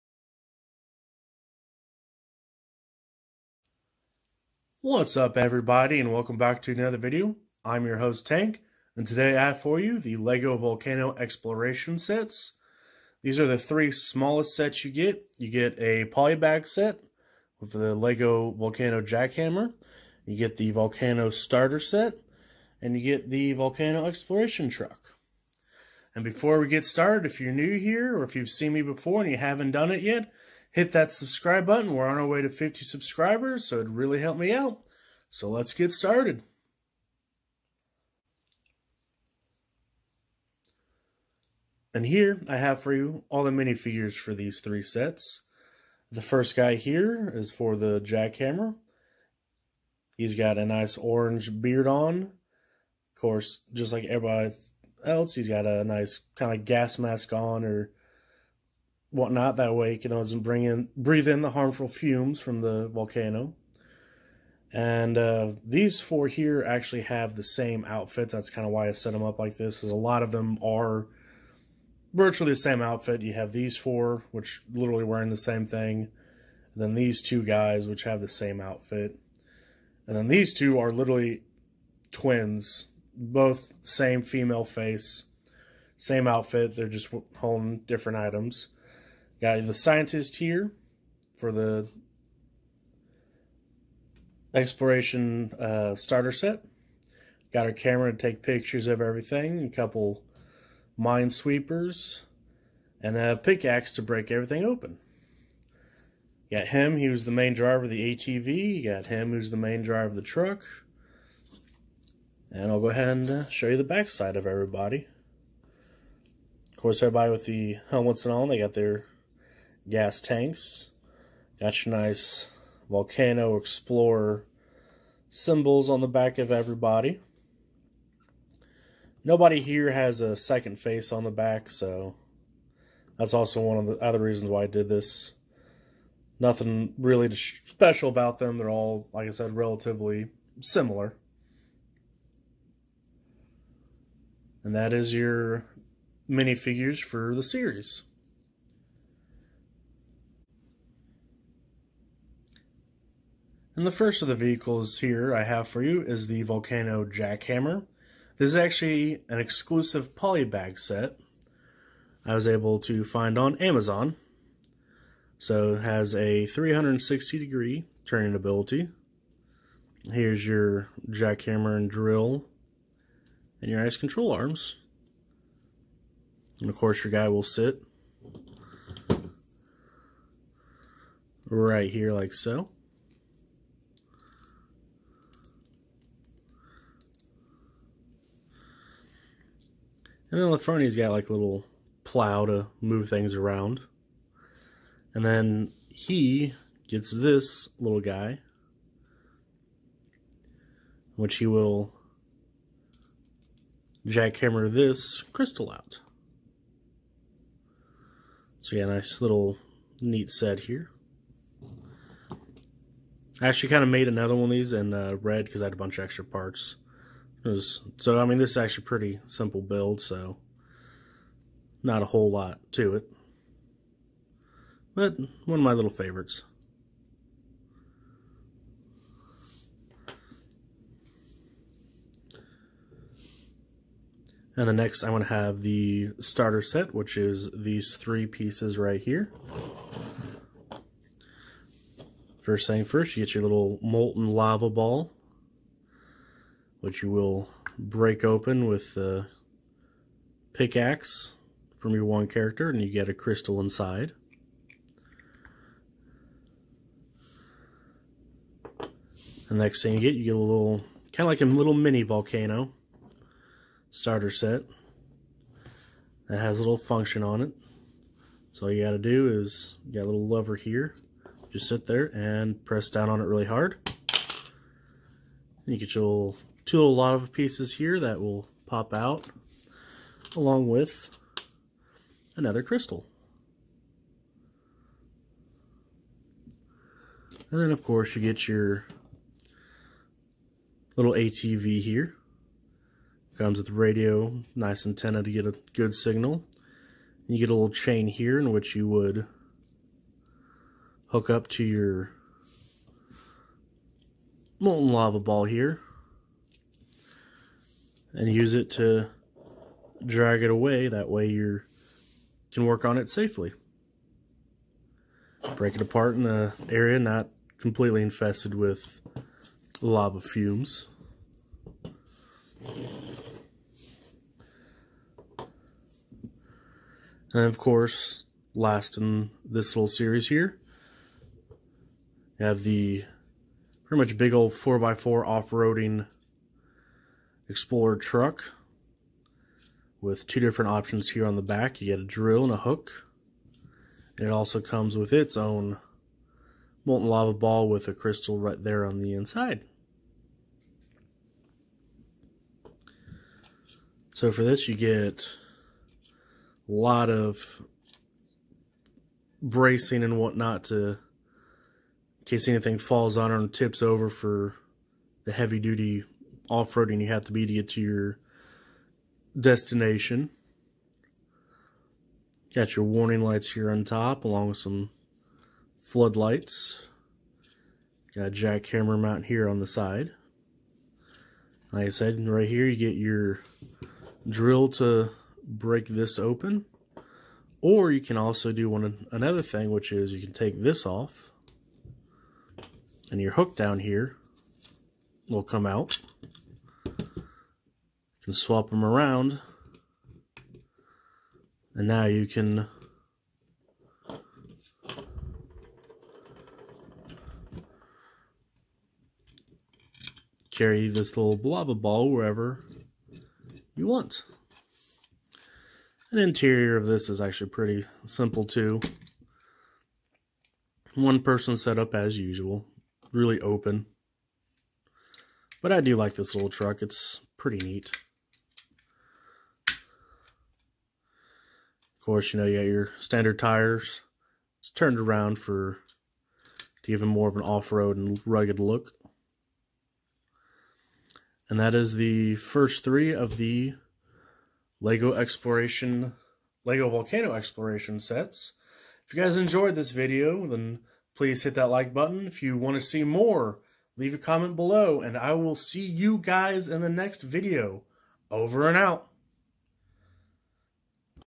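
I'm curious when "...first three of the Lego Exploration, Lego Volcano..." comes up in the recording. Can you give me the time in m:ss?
7:22.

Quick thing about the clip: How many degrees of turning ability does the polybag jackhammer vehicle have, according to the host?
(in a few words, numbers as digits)
360.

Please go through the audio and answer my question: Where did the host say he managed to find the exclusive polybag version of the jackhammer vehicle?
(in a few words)
Amazon.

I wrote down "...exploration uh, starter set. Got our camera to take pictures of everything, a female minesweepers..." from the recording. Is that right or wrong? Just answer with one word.
wrong.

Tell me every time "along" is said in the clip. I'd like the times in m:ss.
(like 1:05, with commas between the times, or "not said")
4:40, 6:14.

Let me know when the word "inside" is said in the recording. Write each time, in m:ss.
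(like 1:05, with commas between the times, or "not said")
4:13, 5:49.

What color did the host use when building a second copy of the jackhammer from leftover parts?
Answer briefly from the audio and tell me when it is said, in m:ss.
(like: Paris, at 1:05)
Red, at 3:35.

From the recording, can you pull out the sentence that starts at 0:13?
These are the three smallest sets you get.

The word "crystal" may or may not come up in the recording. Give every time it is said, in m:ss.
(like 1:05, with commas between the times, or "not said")
3:25, 4:13, 4:42, 5:47.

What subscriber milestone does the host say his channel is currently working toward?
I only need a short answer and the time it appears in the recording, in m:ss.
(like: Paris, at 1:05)
50, at 0:32.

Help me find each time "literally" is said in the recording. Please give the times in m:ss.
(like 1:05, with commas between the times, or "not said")
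1:14, 1:20.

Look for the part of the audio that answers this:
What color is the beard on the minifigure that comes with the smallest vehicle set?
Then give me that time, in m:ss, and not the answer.
0:50.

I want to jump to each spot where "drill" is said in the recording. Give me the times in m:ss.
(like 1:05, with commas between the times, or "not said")
2:51, 5:42, 6:24.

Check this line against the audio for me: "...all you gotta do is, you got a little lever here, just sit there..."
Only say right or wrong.
right.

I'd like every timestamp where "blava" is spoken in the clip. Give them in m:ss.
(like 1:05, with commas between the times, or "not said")
6:51.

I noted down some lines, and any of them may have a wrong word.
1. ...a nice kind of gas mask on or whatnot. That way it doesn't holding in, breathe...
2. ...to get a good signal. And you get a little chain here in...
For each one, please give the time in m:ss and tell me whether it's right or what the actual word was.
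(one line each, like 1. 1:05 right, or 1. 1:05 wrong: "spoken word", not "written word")
1. 0:55 wrong: "bring", not "holding"
2. 4:55 right.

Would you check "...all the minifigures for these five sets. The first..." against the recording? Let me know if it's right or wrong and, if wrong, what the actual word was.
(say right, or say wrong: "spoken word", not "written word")
wrong: "three", not "five".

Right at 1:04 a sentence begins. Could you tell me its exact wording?
And uh, these four here actually have the same outfit.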